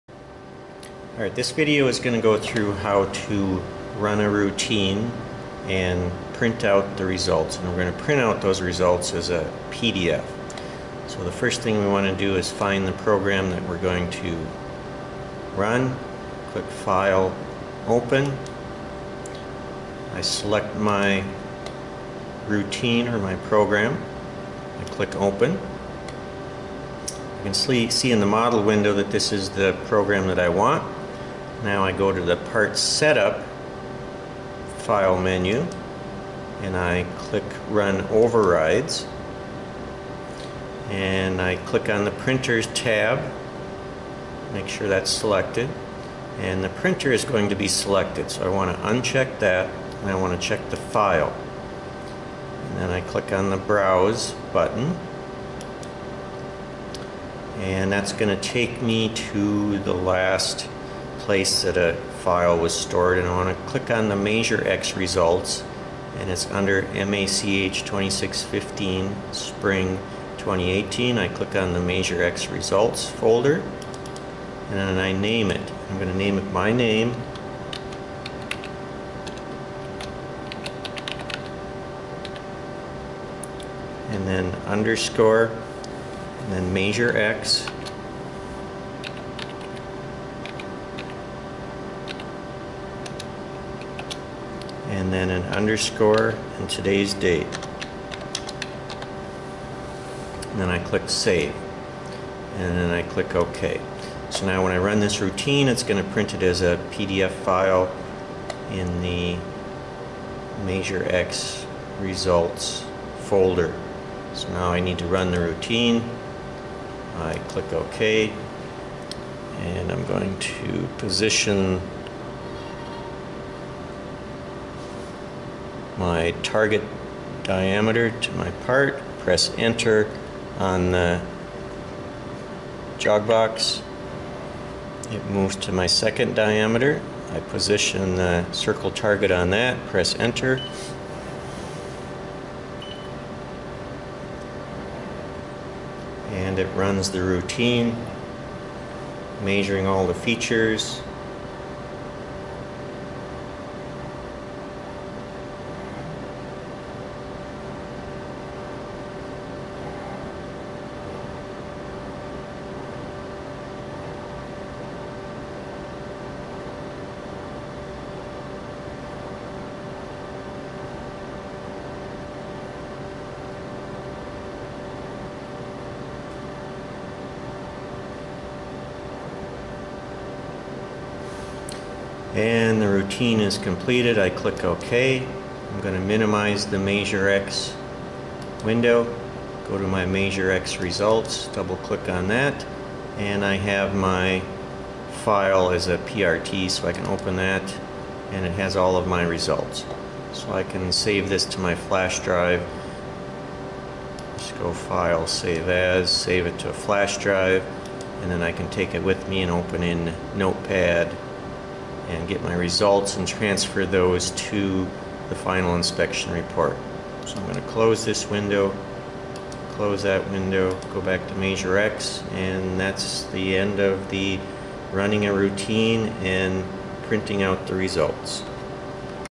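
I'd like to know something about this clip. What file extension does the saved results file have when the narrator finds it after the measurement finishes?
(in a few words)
PRT.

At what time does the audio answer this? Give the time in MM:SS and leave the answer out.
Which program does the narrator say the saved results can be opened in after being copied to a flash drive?
03:30.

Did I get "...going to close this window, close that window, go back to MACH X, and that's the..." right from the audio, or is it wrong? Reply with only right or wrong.
wrong.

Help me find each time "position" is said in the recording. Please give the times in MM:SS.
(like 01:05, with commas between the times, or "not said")
02:00, 02:17.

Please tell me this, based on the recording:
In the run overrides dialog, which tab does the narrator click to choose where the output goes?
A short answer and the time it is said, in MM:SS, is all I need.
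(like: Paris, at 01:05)
Printers, at 00:42.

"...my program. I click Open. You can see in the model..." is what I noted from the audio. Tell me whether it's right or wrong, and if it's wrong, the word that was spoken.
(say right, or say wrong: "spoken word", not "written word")
right.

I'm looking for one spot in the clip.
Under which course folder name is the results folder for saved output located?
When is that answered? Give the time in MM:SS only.
01:06.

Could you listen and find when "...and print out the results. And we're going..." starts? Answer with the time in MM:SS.
00:05.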